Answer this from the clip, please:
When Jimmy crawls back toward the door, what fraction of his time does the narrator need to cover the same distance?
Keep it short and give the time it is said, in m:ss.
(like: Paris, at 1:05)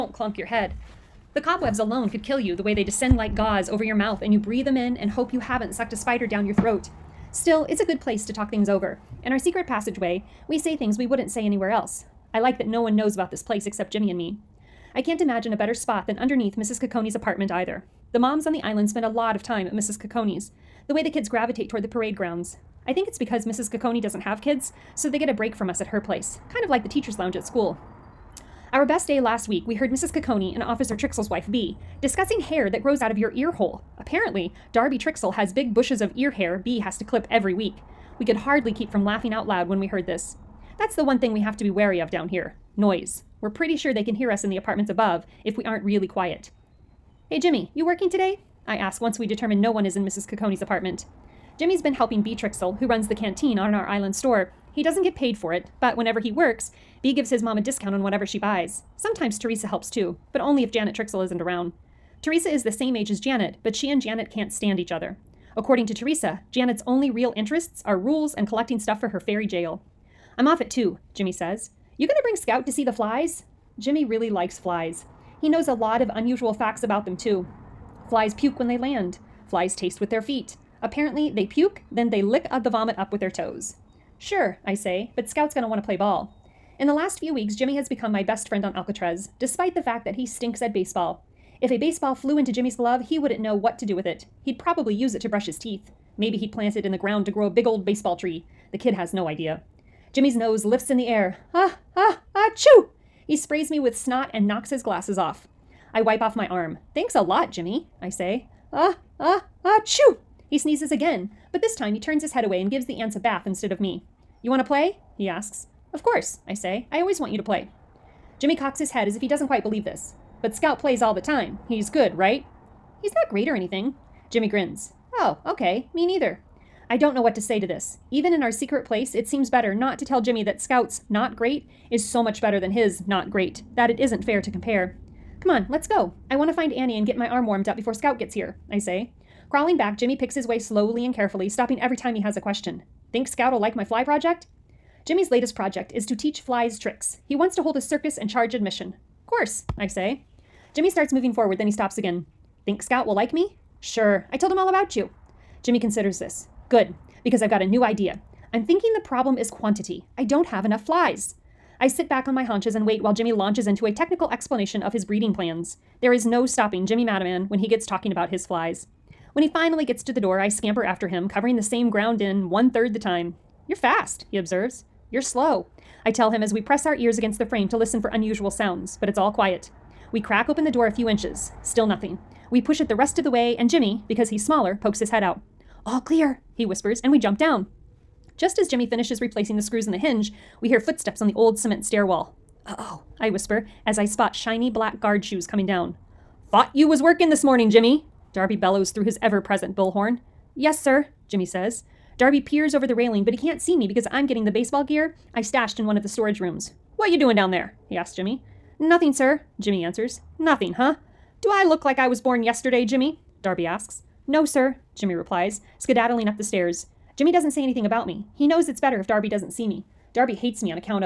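One third, at 2:52.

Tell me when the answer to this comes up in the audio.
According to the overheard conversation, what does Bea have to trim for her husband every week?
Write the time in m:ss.
0:36.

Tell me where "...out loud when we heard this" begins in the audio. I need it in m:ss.
0:39.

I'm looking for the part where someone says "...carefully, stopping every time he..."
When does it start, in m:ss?
2:21.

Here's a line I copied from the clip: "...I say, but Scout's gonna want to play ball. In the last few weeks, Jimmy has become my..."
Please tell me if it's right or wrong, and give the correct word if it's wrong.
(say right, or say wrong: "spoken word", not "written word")
right.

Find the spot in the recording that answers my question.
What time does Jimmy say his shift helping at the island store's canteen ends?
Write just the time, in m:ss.
1:10.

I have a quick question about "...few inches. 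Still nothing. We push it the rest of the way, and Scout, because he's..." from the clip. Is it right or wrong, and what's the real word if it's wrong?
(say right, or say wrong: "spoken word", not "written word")
wrong: "Jimmy", not "Scout".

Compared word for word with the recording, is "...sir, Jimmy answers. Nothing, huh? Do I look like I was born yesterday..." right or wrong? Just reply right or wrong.
right.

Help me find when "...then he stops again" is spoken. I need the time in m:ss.
2:31.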